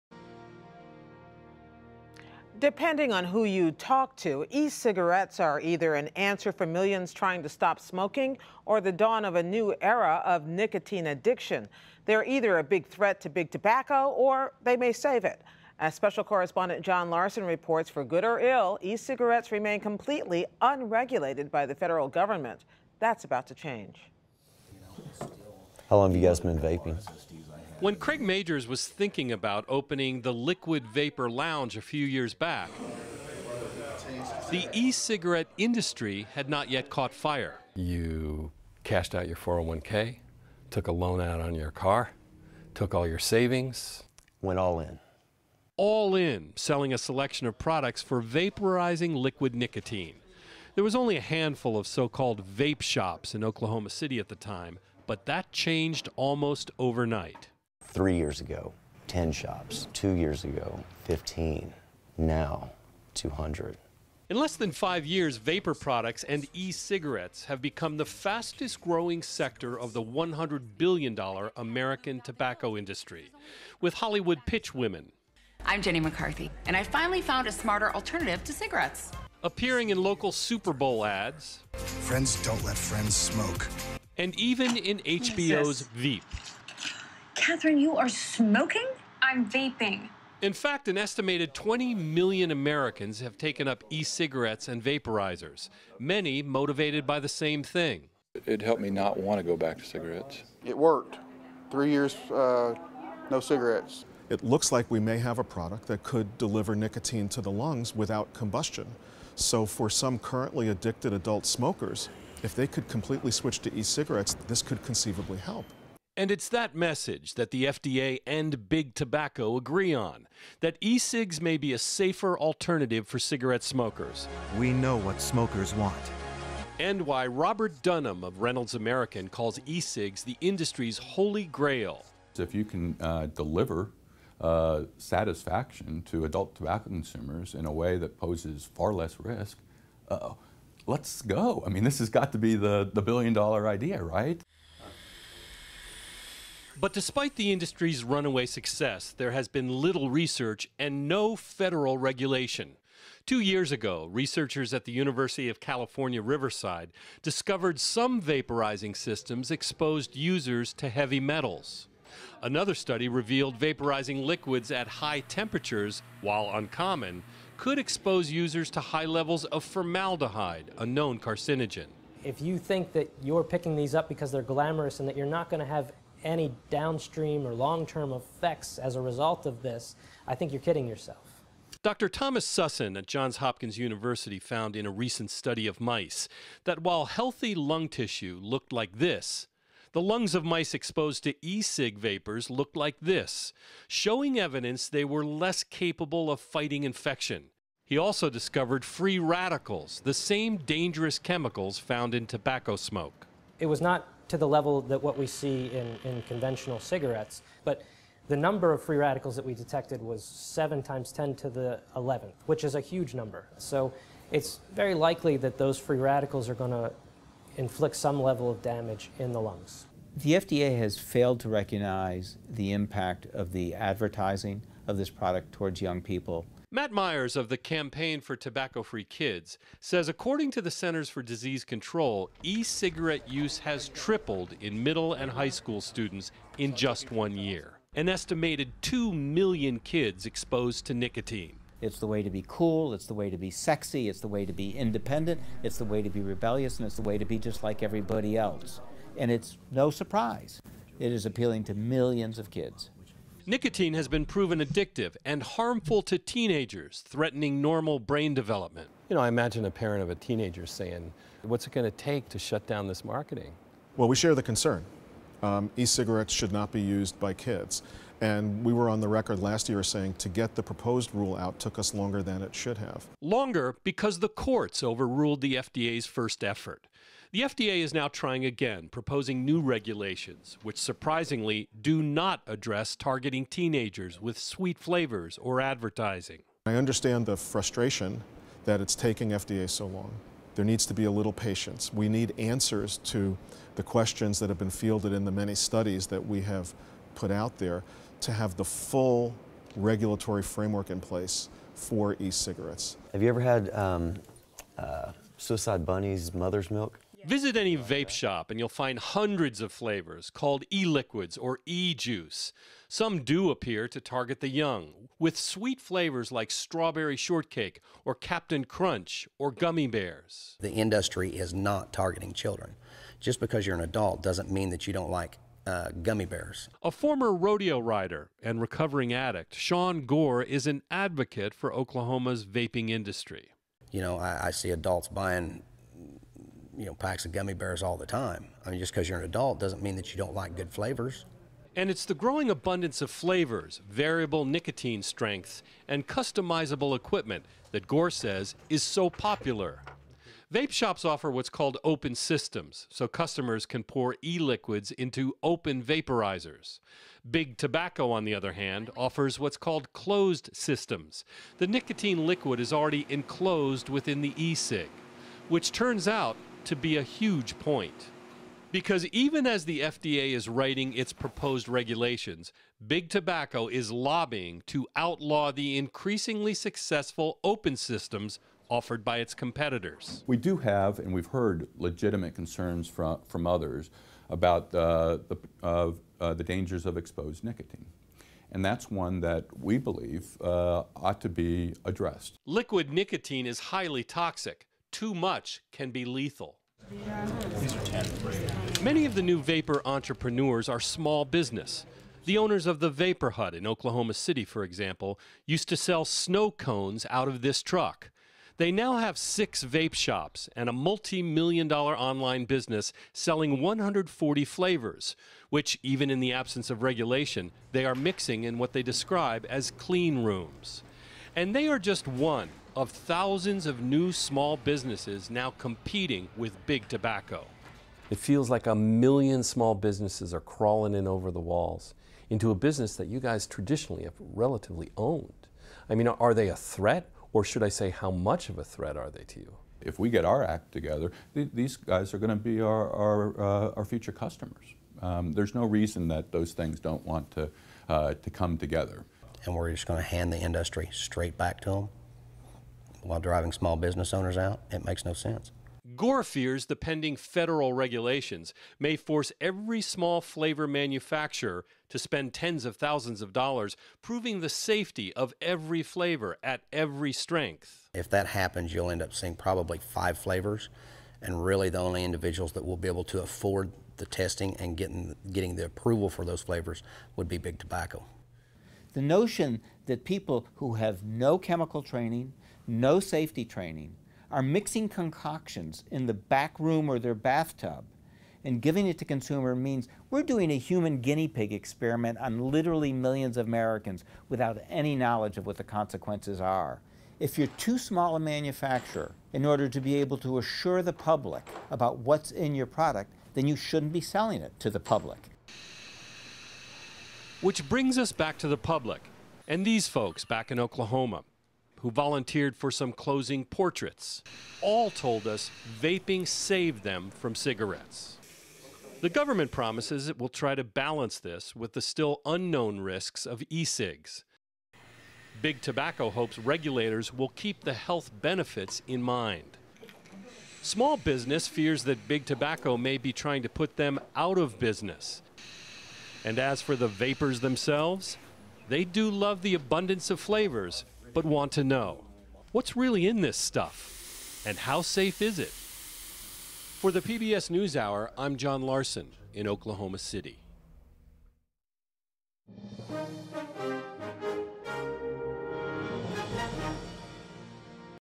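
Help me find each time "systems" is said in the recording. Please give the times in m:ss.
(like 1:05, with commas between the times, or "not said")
2:38, 5:52, 6:00, 6:17.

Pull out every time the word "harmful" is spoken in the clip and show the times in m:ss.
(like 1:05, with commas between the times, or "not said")
4:15.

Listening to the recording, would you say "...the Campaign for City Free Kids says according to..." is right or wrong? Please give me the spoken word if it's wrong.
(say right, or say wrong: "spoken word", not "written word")
wrong: "Tobacco", not "City".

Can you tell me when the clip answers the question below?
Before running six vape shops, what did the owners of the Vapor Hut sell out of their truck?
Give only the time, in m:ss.
6:46.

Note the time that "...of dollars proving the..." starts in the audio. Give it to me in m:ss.
7:43.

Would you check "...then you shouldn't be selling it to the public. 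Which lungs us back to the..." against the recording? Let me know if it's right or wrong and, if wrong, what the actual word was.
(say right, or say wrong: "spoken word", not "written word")
wrong: "brings", not "lungs".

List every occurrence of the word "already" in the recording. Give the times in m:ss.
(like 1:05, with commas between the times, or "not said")
6:02.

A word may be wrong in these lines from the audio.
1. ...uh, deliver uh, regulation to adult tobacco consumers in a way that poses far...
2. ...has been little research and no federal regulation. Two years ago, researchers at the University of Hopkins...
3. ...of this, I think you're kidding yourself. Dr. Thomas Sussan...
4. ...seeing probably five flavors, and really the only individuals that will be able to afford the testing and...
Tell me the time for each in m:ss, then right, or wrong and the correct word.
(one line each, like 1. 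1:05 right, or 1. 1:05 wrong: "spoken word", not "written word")
1. 2:13 wrong: "satisfaction", not "regulation"
2. 2:29 wrong: "California", not "Hopkins"
3. 2:59 right
4. 7:49 right.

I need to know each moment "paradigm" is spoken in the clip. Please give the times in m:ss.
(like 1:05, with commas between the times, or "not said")
not said.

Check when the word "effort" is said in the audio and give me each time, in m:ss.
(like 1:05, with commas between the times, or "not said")
4:36.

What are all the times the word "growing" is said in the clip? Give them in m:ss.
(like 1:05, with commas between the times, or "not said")
1:08, 5:42.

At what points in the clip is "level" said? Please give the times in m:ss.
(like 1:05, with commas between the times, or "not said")
2:49, 3:24, 3:38.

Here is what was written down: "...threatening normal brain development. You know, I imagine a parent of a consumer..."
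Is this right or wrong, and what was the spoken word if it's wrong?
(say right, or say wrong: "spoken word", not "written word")
wrong: "teenager", not "consumer".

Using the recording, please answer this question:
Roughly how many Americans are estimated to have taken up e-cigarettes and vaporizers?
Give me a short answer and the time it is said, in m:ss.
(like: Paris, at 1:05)
20 million, at 1:31.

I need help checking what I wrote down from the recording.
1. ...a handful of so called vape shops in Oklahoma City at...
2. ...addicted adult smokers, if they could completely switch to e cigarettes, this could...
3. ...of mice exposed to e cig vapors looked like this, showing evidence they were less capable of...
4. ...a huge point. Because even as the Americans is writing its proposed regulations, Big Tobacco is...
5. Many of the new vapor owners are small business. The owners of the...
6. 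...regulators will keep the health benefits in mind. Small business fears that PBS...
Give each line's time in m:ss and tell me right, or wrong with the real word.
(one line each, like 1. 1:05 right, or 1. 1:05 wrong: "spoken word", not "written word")
1. 0:51 right
2. 1:50 right
3. 3:10 right
4. 6:06 wrong: "FDA", not "Americans"
5. 6:38 wrong: "entrepreneurs", not "owners"
6. 8:46 wrong: "Big", not "PBS".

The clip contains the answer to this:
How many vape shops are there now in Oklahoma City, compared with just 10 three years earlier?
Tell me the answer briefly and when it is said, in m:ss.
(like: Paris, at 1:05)
200, at 1:03.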